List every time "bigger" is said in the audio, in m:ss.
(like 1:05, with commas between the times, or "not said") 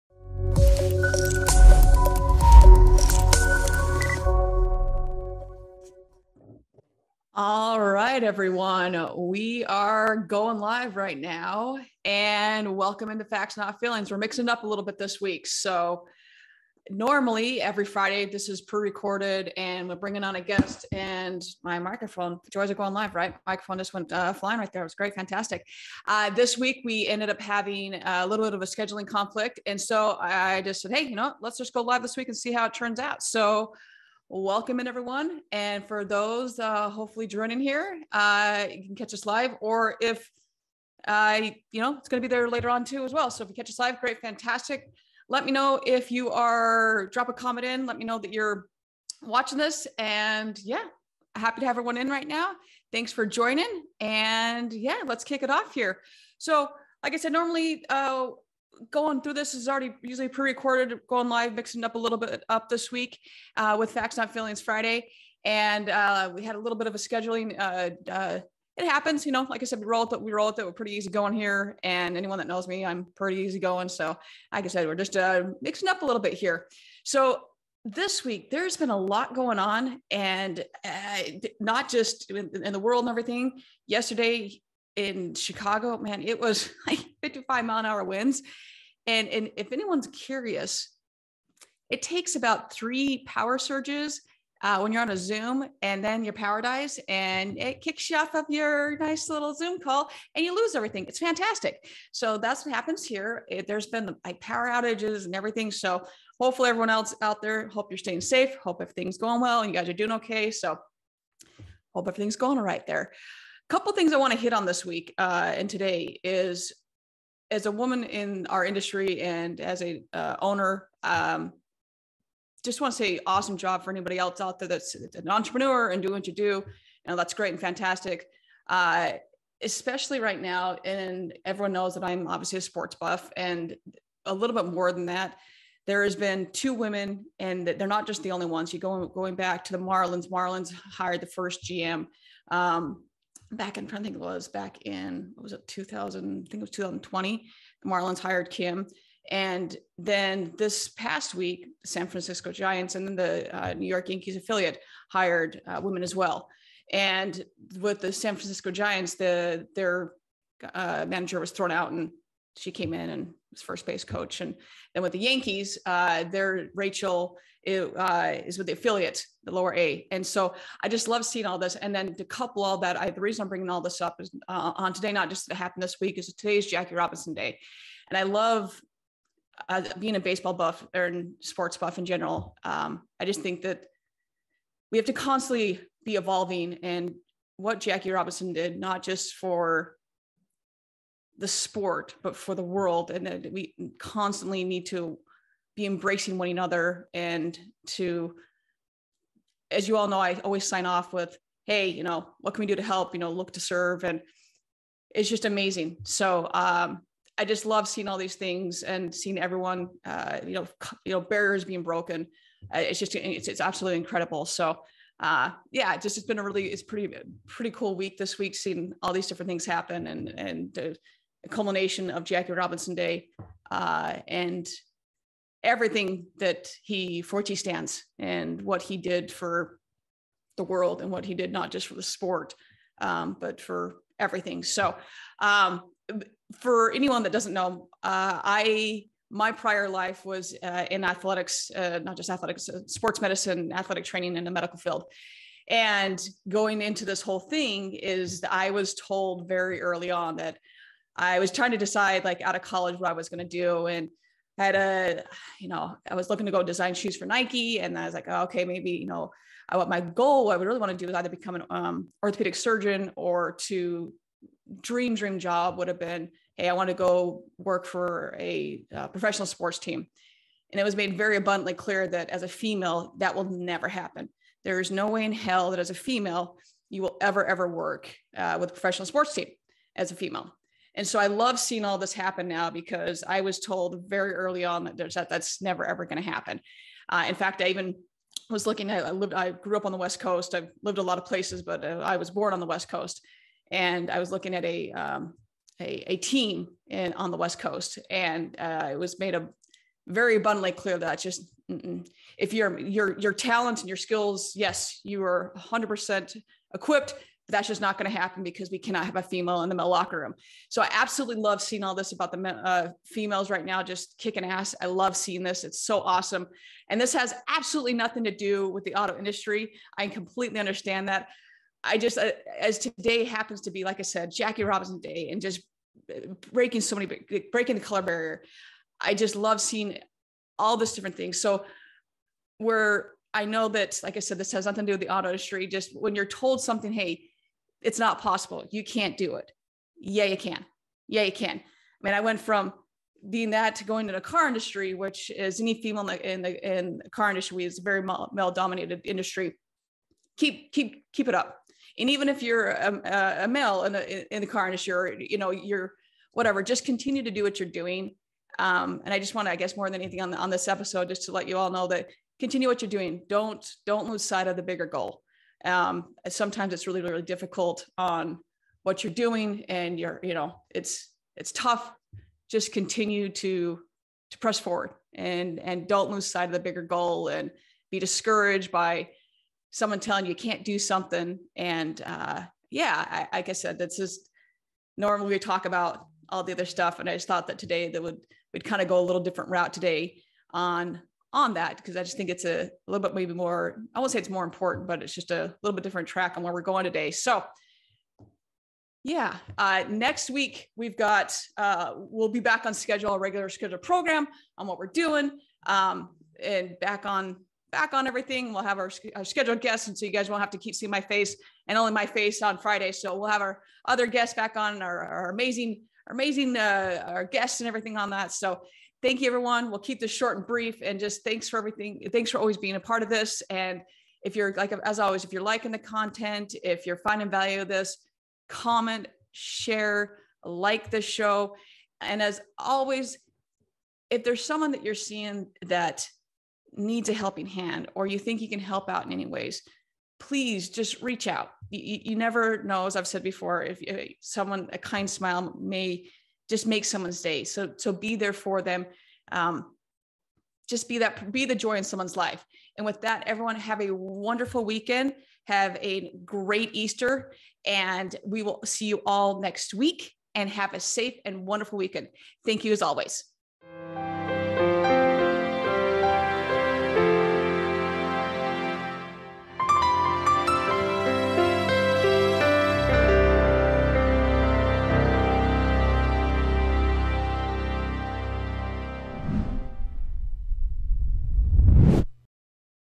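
6:04, 6:16.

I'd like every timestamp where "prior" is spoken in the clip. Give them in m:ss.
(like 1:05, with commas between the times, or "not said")
3:59.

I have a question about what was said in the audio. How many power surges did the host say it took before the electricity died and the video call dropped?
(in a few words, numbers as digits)
3.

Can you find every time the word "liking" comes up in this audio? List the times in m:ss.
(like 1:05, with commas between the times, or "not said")
7:05.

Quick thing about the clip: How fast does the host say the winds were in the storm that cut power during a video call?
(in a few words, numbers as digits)
55 mph.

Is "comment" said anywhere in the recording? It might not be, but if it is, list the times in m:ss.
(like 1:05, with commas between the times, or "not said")
0:47, 7:08.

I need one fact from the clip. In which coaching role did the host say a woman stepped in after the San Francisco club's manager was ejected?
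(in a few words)
First base coach.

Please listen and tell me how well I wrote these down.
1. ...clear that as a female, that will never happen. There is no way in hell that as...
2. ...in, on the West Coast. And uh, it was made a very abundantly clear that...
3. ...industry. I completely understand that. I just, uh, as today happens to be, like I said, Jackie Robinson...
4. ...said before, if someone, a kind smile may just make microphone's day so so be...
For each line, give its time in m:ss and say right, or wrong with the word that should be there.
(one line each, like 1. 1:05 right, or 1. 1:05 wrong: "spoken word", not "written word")
1. 4:31 right
2. 4:56 right
3. 5:19 right
4. 7:23 wrong: "someone", not "microphone".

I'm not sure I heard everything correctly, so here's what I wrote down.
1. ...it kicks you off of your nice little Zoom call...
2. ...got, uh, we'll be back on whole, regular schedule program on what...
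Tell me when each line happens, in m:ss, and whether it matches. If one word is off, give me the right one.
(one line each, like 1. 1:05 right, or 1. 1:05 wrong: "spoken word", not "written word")
1. 1:37 right
2. 6:40 wrong: "schedule", not "whole".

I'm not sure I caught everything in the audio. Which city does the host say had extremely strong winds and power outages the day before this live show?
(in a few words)
Chicago.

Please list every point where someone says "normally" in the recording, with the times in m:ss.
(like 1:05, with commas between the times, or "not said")
0:16, 0:57, 6:24.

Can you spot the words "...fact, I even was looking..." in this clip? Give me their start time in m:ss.
4:47.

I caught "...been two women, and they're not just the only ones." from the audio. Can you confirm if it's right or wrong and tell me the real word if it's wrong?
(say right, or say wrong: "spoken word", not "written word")
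right.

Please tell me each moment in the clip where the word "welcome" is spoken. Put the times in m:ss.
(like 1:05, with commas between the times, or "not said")
0:12, 0:34.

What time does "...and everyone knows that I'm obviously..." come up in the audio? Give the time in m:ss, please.
2:10.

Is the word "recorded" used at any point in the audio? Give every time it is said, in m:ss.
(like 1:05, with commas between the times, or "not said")
0:18, 1:00.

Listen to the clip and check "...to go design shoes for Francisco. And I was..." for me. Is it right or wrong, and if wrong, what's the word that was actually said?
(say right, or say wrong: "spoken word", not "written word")
wrong: "Nike", not "Francisco".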